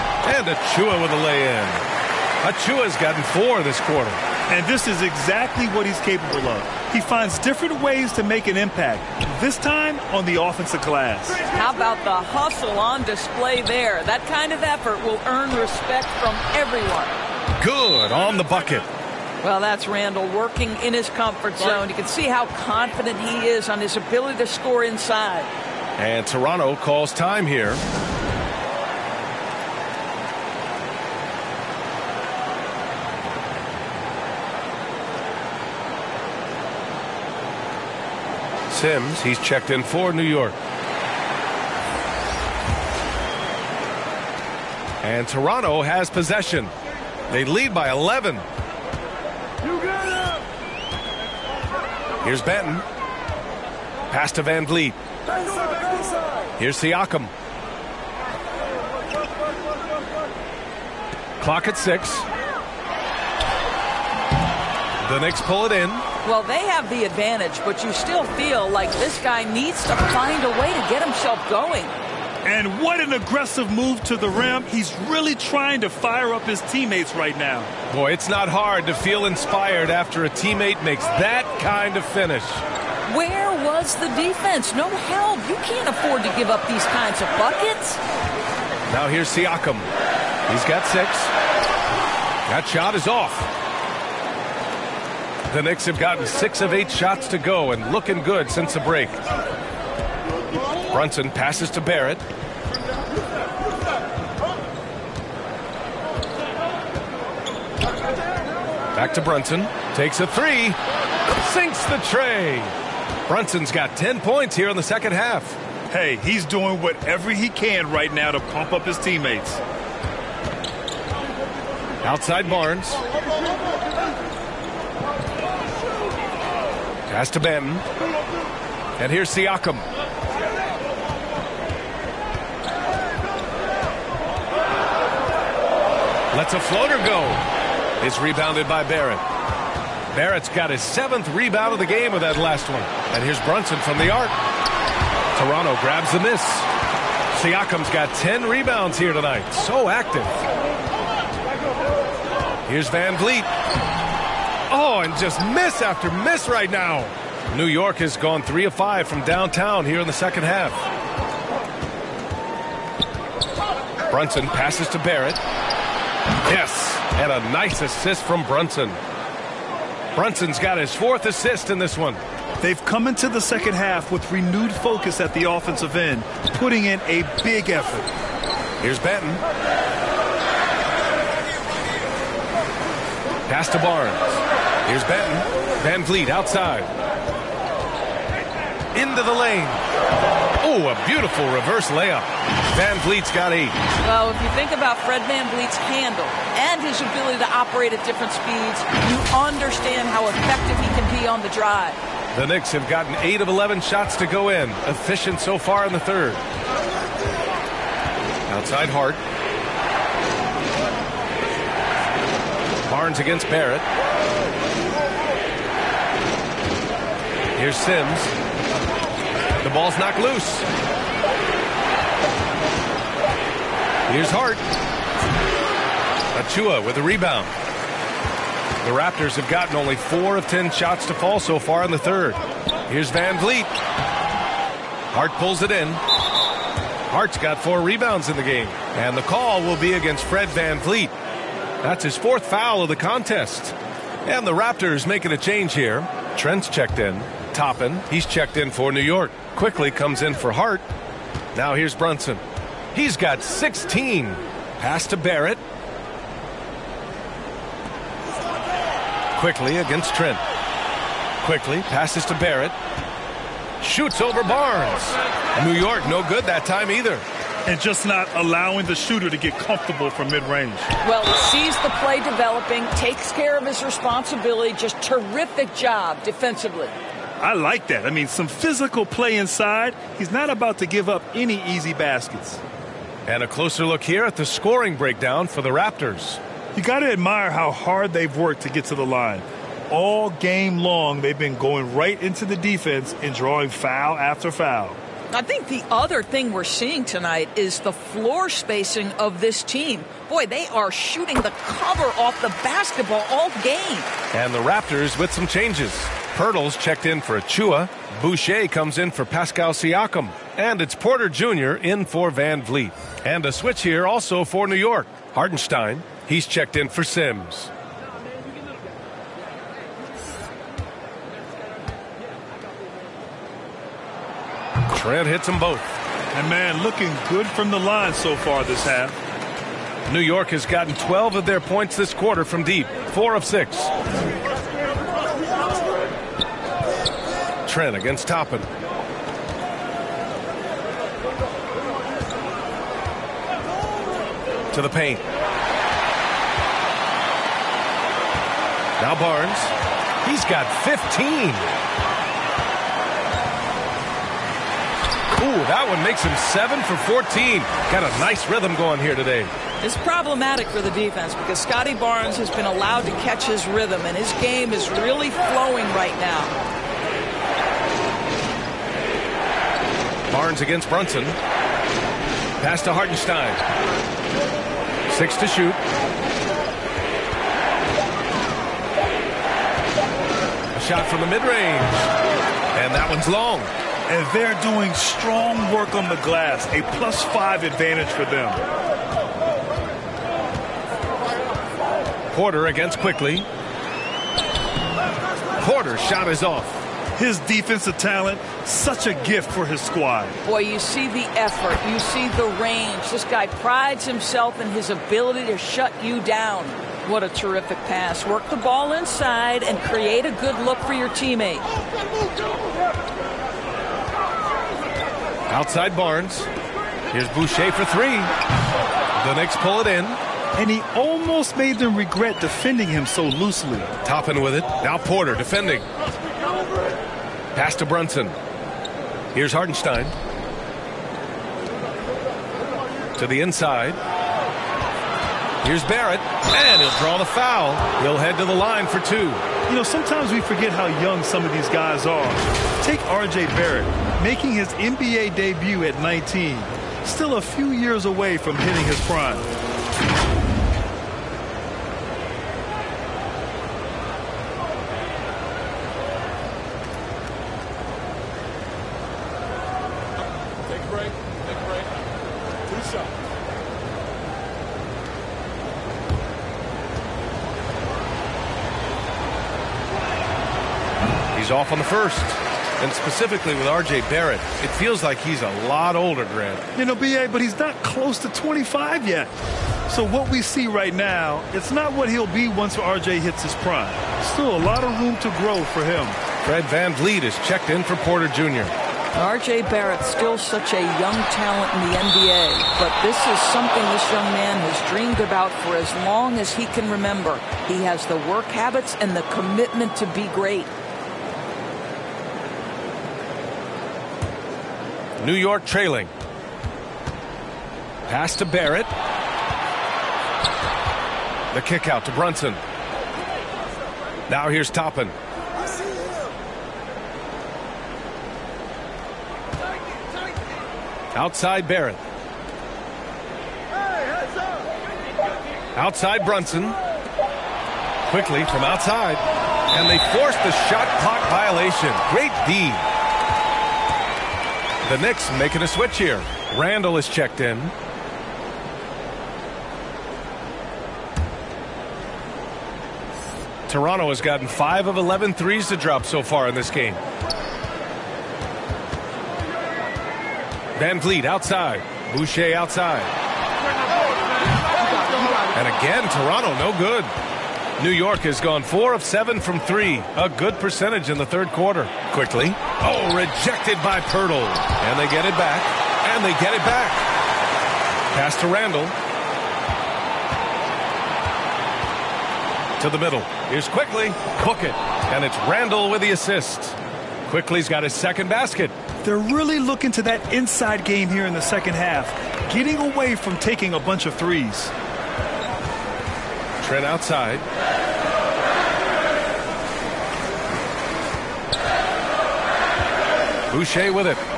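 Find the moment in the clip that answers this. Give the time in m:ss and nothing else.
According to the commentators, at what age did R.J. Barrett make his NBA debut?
7:26.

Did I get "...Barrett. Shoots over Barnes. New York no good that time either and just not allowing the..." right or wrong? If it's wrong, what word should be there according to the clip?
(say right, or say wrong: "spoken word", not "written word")
right.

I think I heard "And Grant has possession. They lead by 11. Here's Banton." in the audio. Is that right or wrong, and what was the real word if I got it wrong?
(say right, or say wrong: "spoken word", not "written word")
wrong: "Toronto", not "Grant".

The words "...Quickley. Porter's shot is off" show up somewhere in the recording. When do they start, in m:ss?
6:32.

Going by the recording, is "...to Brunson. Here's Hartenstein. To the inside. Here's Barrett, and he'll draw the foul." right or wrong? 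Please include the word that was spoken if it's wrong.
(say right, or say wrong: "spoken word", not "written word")
right.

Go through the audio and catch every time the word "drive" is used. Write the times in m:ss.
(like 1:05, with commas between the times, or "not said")
3:21.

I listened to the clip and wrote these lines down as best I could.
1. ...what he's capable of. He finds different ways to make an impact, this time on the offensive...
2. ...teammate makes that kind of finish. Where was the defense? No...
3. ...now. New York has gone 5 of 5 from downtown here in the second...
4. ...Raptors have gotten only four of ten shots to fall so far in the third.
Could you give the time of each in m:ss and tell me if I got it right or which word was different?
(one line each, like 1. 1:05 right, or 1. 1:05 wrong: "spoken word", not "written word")
1. 0:05 right
2. 1:20 right
3. 2:36 wrong: "3", not "5"
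4. 3:48 right.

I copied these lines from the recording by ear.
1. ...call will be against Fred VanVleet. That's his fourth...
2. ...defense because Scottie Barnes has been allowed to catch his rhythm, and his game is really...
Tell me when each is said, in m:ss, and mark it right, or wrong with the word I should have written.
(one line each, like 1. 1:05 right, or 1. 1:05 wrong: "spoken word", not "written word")
1. 3:59 right
2. 6:00 right.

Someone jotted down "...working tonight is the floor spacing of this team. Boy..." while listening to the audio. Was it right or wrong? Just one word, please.
wrong.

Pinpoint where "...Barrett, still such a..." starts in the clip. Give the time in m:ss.
8:09.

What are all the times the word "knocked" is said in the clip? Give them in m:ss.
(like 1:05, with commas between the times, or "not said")
3:39.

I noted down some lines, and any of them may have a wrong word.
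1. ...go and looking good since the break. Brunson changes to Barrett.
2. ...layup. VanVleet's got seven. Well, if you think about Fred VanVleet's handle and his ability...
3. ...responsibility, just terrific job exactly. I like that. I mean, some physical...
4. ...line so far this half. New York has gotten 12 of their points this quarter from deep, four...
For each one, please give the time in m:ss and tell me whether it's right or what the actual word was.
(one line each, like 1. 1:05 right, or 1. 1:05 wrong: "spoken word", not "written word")
1. 1:37 wrong: "passes", not "changes"
2. 3:11 wrong: "eight", not "seven"
3. 4:33 wrong: "defensively", not "exactly"
4. 5:27 right.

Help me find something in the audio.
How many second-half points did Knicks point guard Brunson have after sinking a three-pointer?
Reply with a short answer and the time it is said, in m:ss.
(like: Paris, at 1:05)
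10, at 1:53.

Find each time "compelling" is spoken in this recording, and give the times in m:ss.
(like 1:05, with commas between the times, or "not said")
not said.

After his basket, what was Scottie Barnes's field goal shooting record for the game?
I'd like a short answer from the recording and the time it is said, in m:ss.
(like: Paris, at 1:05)
7 for 14, at 5:56.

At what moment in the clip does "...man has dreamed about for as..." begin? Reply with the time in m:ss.
8:14.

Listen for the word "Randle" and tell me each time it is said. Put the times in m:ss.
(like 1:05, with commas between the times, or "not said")
0:19, 8:56, 9:28, 9:35.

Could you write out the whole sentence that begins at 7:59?
So what we see right now, it's not what he'll be once R.J.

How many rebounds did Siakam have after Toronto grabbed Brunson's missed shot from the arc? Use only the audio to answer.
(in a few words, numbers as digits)
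10.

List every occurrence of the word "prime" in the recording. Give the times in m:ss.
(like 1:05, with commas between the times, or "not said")
7:29, 8:03.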